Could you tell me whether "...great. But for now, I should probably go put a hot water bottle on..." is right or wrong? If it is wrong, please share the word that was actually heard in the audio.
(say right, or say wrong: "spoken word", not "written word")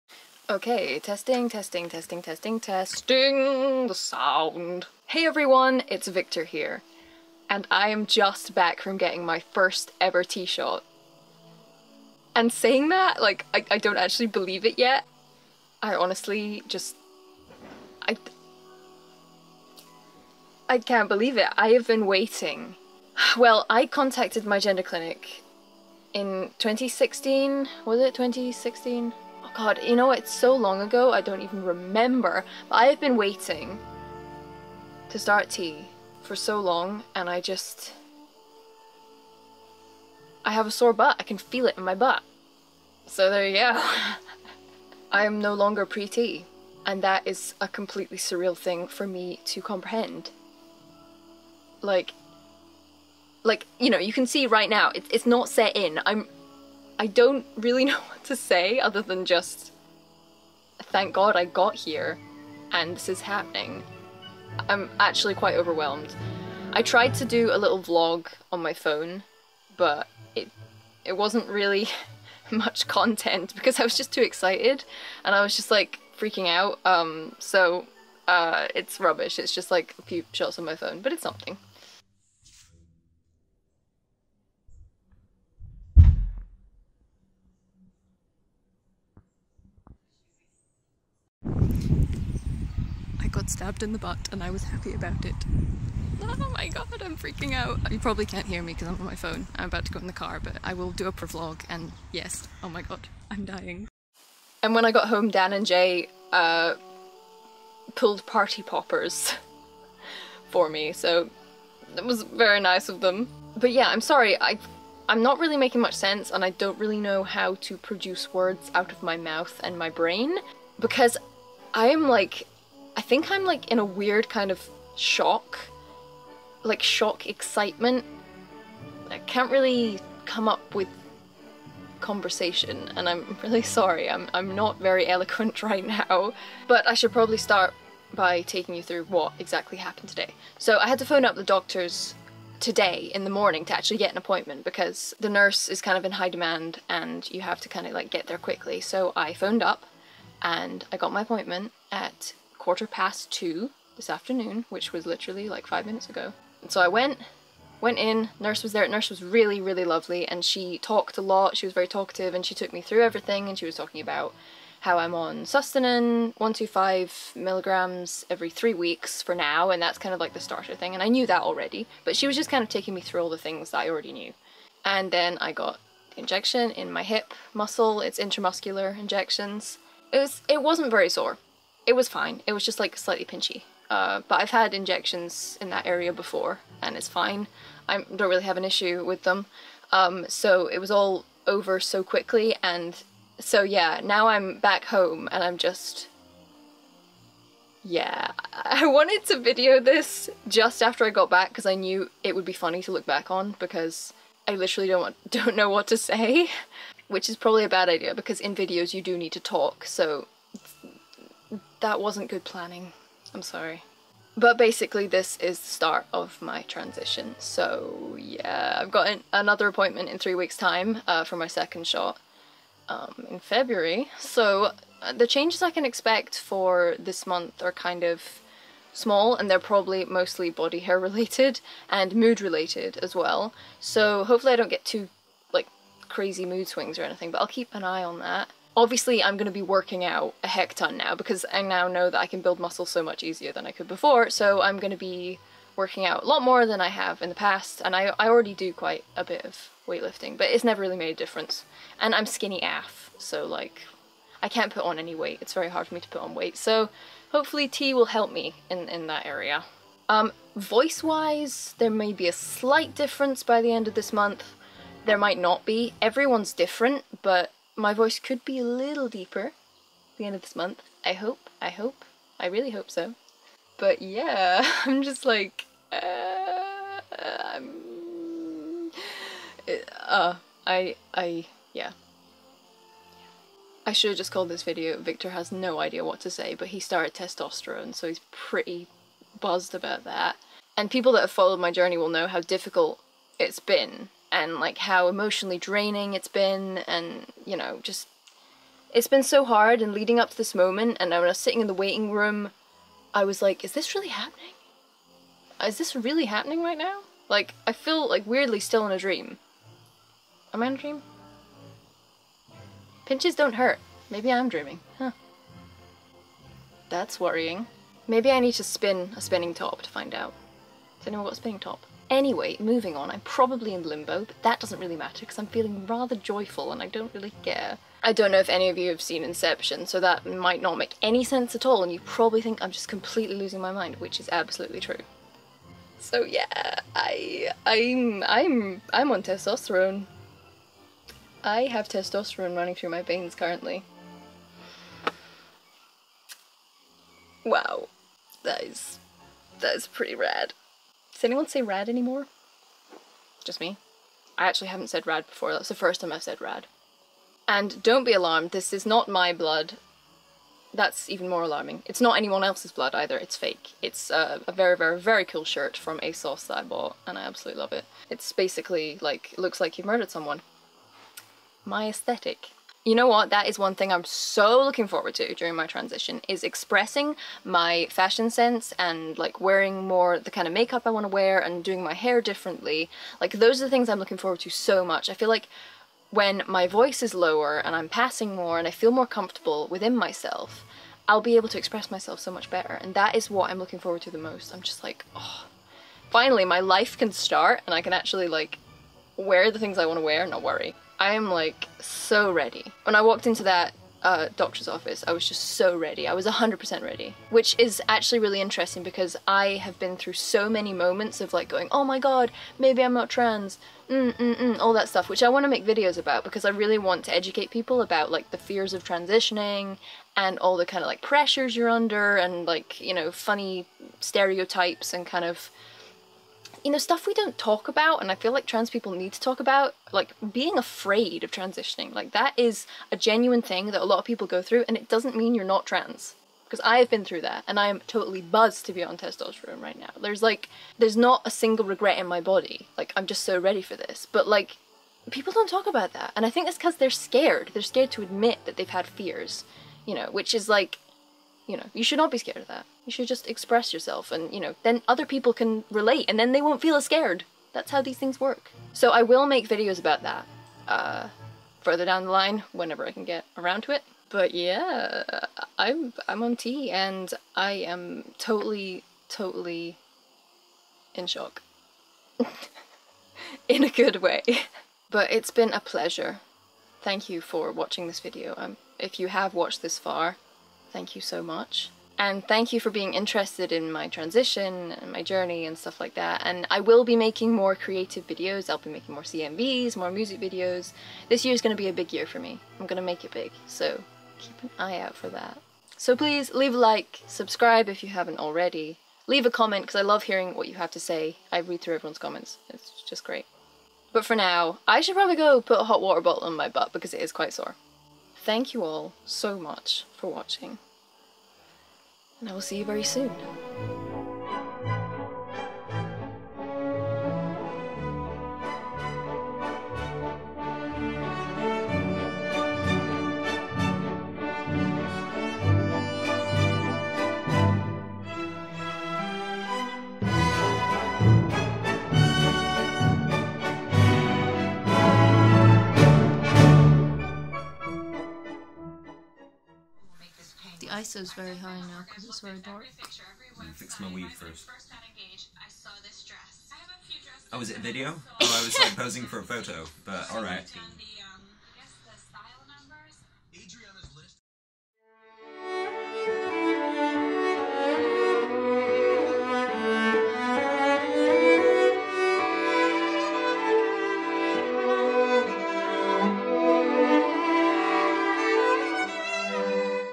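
right.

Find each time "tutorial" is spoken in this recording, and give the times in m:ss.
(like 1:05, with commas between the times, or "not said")
not said.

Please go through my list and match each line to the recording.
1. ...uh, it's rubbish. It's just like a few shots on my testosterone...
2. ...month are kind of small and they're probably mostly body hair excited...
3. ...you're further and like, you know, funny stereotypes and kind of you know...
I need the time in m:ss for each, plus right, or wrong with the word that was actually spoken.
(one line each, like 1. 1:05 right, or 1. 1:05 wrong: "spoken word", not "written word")
1. 1:18 wrong: "phone", not "testosterone"
2. 3:47 wrong: "related", not "excited"
3. 7:01 wrong: "under", not "further".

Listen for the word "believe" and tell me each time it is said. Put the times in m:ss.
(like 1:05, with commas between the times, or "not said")
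0:14, 0:21.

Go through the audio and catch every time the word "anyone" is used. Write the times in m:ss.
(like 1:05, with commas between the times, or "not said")
5:21, 5:51, 6:02.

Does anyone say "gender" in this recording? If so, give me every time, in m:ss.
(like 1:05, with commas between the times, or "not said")
0:24.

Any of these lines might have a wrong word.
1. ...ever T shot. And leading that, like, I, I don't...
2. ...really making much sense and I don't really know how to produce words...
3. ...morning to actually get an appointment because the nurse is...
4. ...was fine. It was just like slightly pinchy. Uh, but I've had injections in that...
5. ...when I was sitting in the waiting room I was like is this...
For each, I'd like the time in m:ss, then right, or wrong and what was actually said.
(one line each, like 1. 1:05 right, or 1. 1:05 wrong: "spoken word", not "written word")
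1. 0:10 wrong: "saying", not "leading"
2. 1:55 right
3. 2:23 right
4. 3:01 right
5. 5:01 right.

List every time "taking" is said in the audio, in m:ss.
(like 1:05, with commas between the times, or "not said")
2:18, 2:52.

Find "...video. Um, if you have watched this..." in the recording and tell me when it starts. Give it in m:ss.
7:57.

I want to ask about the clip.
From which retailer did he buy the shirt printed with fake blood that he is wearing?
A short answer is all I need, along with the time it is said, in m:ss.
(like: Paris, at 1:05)
ASOS, at 6:05.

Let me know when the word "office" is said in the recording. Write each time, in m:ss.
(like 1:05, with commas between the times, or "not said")
6:44.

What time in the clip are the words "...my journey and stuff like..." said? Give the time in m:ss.
8:04.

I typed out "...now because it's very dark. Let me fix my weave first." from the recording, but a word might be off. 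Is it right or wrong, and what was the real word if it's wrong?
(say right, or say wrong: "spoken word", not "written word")
right.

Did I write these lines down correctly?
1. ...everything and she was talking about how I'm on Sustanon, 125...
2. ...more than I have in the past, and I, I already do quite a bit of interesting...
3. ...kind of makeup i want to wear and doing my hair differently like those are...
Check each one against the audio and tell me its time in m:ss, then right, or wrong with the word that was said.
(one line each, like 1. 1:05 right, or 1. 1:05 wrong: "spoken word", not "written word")
1. 2:43 right
2. 4:06 wrong: "weightlifting", not "interesting"
3. 6:20 right.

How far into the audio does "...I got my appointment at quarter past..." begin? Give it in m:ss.
2:30.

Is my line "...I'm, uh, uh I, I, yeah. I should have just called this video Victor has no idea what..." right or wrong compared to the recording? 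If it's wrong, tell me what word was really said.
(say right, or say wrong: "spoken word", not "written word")
right.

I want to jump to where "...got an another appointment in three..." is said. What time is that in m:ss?
3:38.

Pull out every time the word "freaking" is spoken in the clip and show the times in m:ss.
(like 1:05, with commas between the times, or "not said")
1:16, 1:37.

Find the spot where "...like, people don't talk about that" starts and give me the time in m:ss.
7:24.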